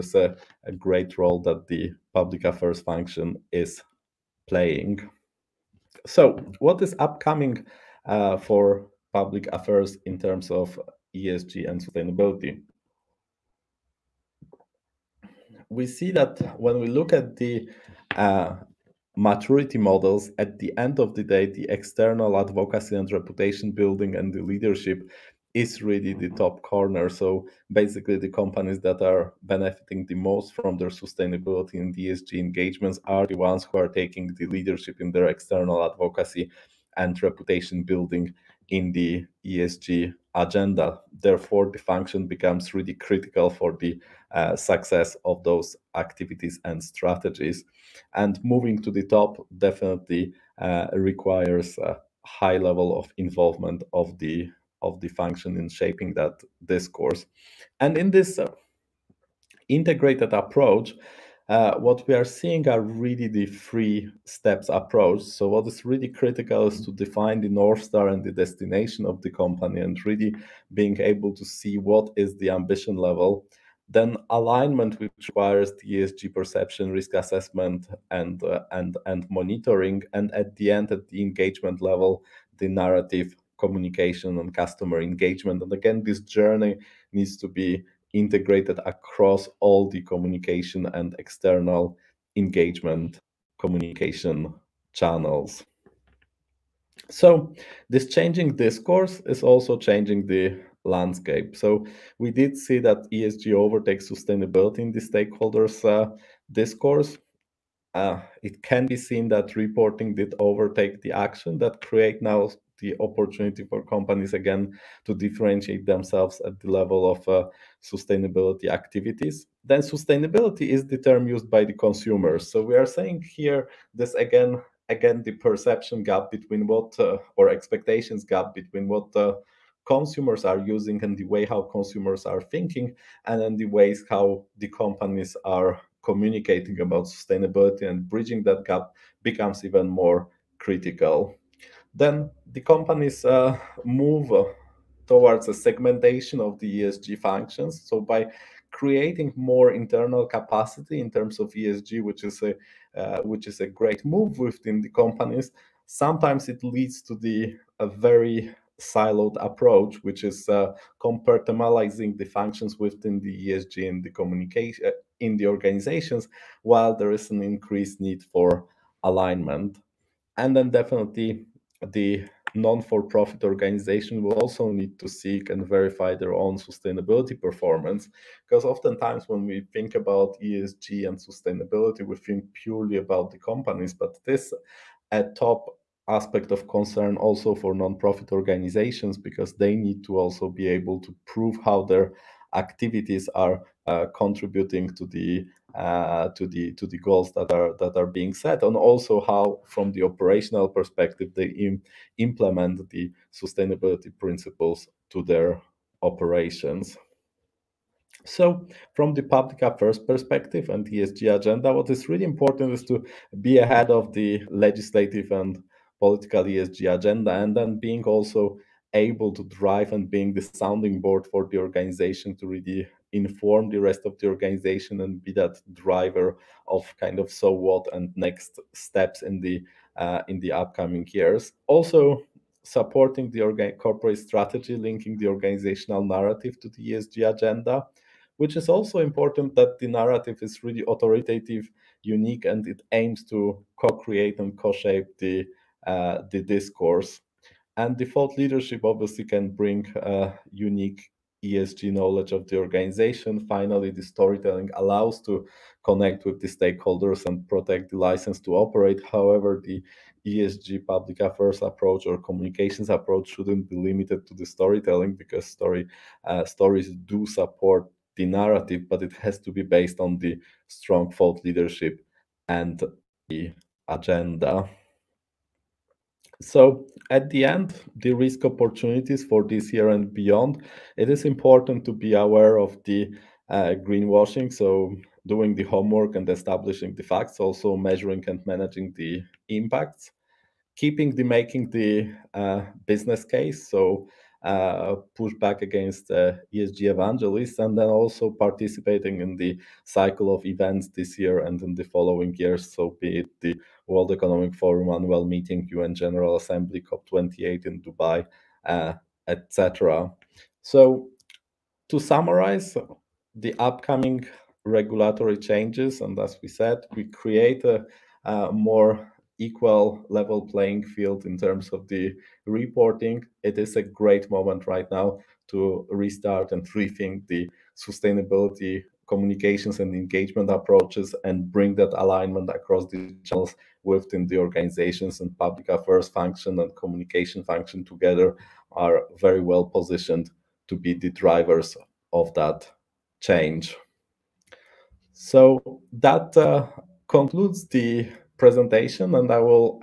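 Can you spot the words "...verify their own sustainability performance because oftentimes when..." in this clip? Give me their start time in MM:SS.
02:55.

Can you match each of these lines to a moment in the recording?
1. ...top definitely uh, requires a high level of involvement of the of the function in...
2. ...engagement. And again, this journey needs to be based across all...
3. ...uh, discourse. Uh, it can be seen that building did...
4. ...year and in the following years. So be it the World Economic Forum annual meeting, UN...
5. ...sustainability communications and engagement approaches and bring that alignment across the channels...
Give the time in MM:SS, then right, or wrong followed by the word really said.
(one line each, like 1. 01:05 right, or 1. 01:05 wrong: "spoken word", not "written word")
1. 00:49 right
2. 01:24 wrong: "integrated", not "based"
3. 01:45 wrong: "reporting", not "building"
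4. 05:01 right
5. 05:27 right.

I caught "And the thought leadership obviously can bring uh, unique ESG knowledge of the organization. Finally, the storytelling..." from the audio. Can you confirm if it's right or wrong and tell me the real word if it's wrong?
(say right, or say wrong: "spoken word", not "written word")
right.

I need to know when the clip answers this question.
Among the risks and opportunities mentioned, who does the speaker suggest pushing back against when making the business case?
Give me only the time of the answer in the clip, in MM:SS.
04:56.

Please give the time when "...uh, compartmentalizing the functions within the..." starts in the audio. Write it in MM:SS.
02:40.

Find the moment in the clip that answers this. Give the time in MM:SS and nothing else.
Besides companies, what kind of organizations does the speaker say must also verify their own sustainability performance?
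02:52.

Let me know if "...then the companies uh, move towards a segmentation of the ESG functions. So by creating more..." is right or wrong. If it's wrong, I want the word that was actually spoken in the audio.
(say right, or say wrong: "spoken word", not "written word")
right.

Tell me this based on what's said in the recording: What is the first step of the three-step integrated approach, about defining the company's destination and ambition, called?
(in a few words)
North Star.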